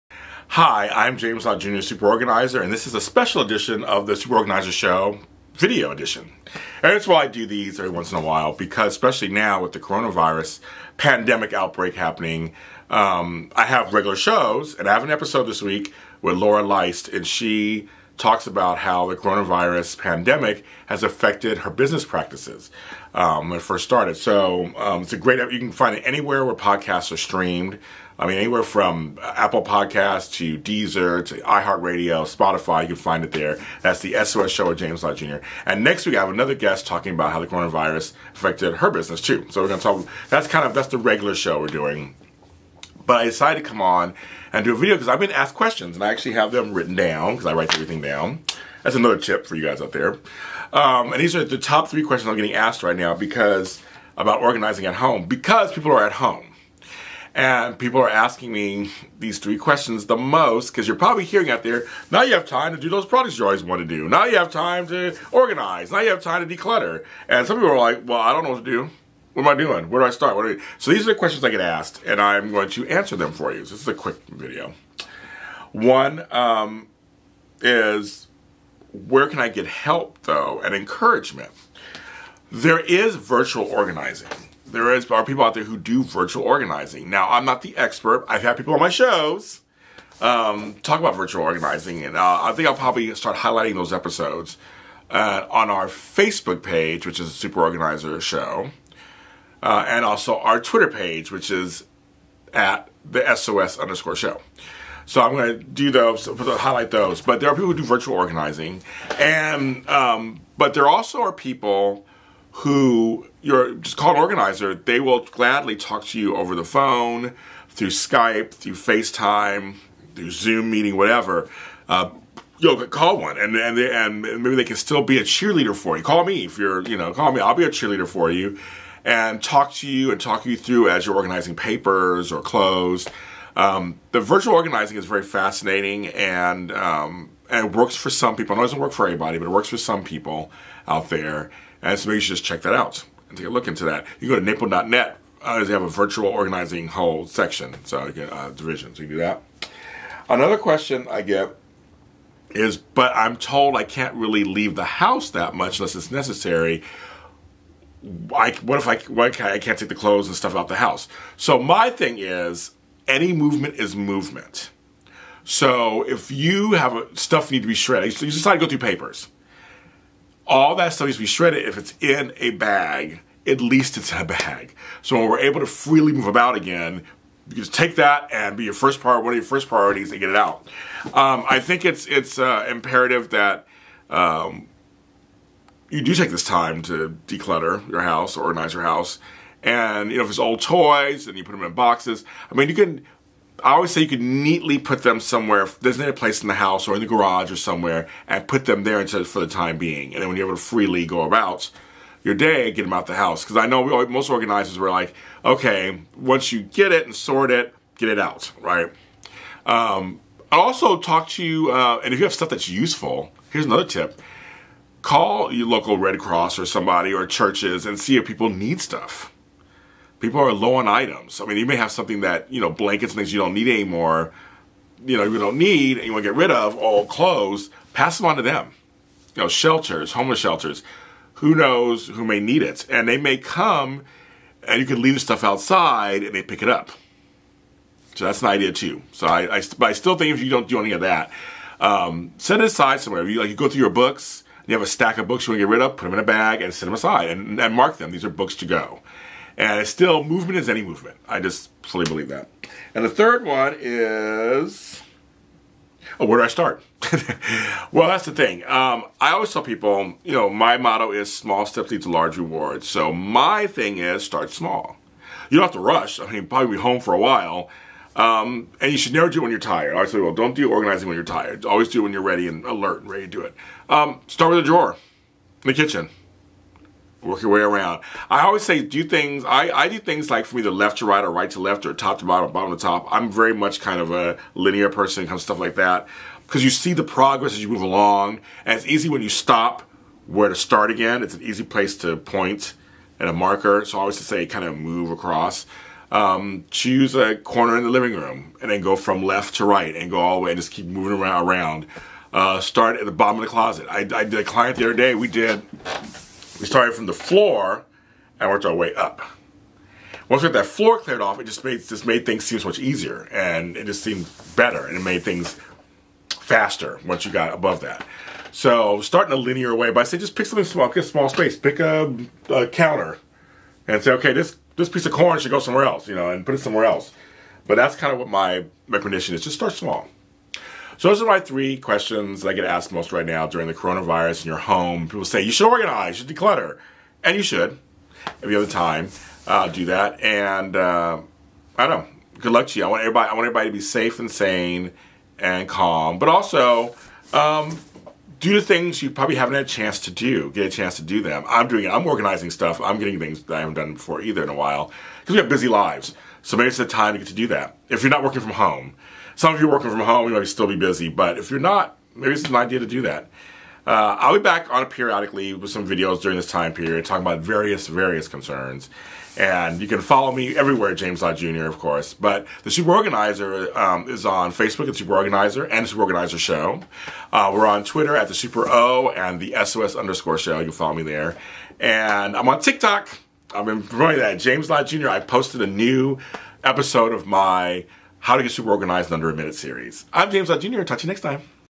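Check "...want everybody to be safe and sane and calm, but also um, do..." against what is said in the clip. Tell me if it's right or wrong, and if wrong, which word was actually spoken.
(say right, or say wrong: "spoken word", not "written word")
right.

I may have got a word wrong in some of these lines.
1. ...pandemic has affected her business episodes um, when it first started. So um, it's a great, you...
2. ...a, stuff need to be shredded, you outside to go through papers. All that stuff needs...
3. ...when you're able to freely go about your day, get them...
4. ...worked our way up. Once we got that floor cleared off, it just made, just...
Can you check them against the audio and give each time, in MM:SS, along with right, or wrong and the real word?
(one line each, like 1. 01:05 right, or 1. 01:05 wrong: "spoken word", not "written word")
1. 00:19 wrong: "practices", not "episodes"
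2. 02:46 wrong: "decide", not "outside"
3. 03:20 right
4. 05:08 right.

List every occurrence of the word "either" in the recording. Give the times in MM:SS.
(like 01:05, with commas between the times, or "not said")
04:40, 05:54.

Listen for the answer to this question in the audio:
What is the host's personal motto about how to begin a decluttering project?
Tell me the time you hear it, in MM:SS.
04:21.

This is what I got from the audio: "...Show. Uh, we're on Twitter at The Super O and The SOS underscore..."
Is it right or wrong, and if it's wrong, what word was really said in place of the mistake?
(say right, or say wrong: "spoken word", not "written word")
right.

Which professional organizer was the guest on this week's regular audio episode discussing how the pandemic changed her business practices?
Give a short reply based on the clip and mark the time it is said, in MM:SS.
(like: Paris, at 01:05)
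Laura Leist, at 00:16.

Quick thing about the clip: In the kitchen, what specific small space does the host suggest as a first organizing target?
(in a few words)
A drawer.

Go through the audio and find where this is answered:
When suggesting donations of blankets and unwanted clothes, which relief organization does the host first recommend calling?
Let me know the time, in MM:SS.
03:35.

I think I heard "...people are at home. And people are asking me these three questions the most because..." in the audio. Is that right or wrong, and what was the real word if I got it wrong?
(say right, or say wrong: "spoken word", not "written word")
right.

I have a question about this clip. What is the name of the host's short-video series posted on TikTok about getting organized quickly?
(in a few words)
How to Get Super Organized in Under a Minute.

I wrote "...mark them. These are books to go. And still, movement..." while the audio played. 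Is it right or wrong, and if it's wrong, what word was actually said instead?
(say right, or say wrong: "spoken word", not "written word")
right.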